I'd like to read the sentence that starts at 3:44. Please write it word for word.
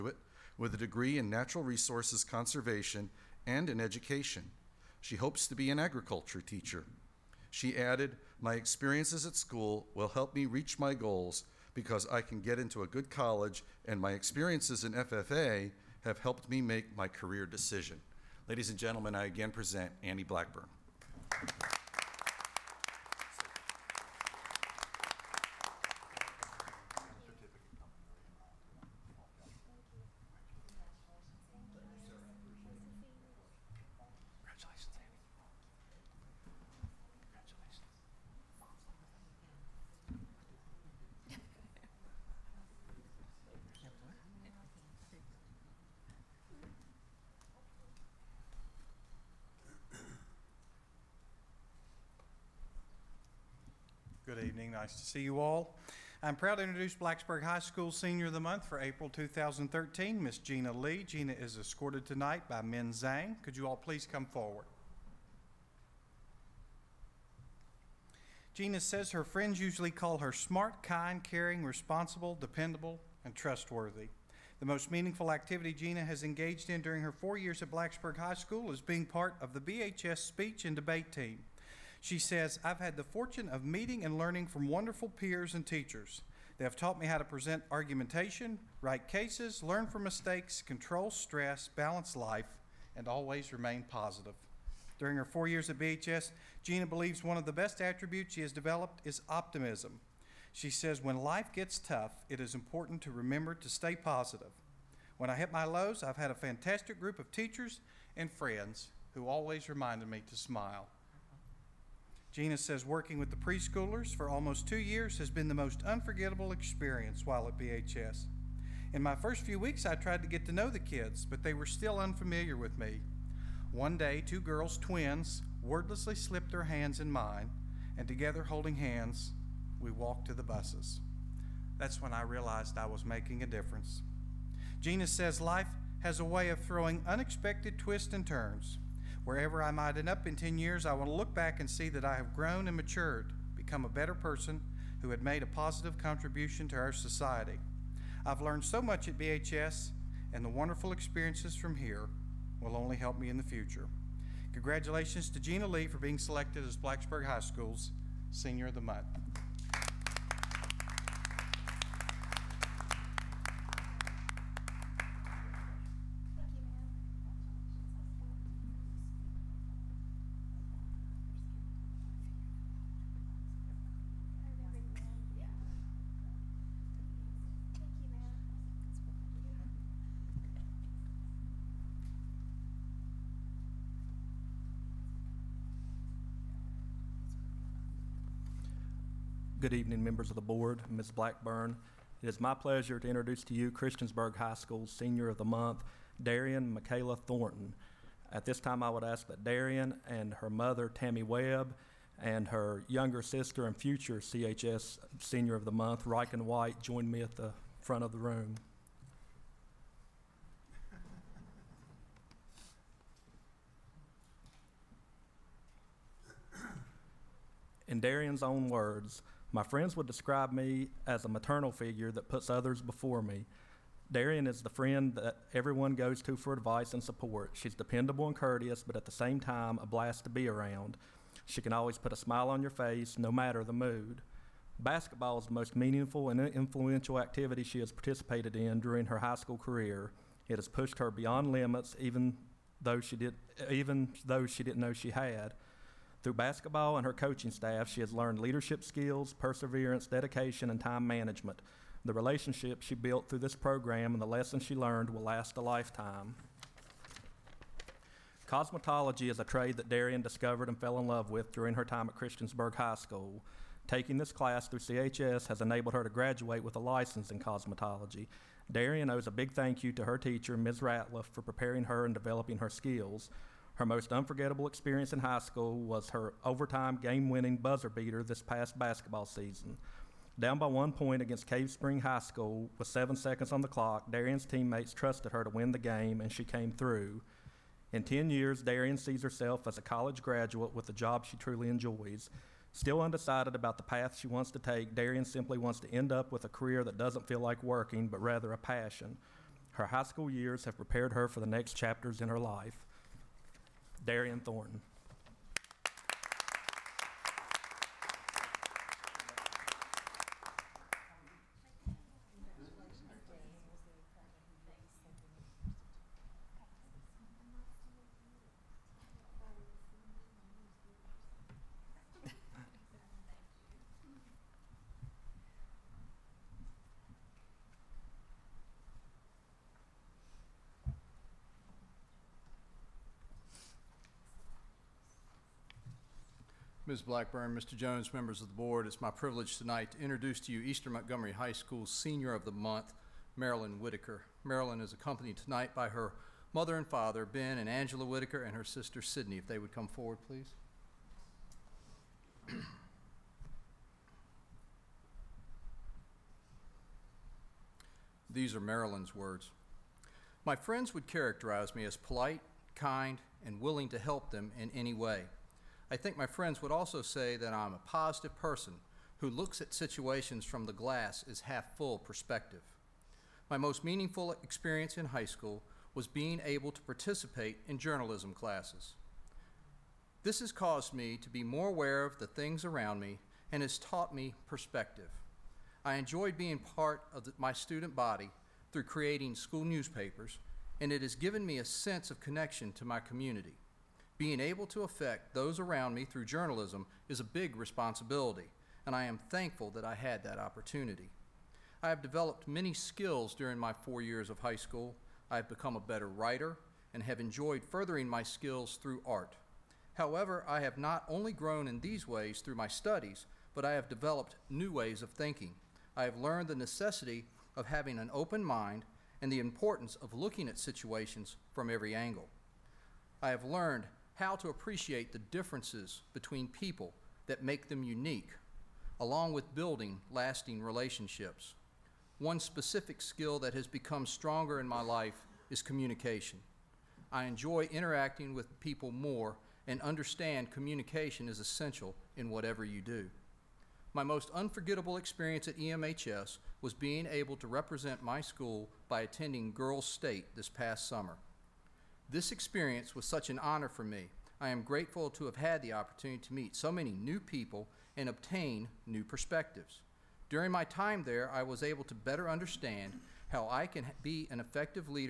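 Darian is the friend that everyone goes to for advice and support.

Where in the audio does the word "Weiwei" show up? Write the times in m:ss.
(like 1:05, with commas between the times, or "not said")
not said.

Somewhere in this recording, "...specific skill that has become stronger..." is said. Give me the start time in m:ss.
7:12.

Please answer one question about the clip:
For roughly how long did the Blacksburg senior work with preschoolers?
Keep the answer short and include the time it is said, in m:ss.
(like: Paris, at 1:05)
almost 2 years, at 1:54.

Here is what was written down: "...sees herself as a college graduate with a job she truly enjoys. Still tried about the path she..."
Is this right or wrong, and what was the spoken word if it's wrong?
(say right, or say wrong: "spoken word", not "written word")
wrong: "undecided", not "tried".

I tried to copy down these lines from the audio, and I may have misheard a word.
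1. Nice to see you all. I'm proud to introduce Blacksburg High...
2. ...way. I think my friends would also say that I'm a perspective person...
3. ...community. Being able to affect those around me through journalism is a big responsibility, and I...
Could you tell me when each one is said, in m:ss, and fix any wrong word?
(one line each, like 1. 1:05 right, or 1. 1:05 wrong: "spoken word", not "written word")
1. 0:54 right
2. 6:04 wrong: "positive", not "perspective"
3. 6:32 right.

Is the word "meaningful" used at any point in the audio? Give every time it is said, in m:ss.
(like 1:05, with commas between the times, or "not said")
1:14, 3:55, 6:13.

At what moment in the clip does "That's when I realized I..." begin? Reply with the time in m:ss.
2:11.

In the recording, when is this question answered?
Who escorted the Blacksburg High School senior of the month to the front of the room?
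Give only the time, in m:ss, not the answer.
1:02.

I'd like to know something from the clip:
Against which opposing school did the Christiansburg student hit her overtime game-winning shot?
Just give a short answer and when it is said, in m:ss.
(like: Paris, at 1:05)
Cave Spring High School, at 4:41.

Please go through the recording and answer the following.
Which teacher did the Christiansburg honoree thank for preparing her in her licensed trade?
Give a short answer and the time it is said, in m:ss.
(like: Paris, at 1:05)
Ms. Ratliff, at 4:30.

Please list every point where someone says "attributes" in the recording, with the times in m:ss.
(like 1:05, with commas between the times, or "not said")
1:37.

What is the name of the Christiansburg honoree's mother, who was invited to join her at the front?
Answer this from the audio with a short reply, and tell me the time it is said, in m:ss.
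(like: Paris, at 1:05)
Tammy Webb, at 3:20.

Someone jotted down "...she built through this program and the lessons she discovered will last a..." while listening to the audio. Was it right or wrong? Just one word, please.
wrong.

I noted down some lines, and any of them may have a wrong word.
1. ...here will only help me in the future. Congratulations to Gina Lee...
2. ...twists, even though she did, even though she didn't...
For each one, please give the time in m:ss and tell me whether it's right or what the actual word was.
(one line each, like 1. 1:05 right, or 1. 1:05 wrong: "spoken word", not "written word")
1. 2:31 right
2. 4:01 wrong: "limits", not "twists".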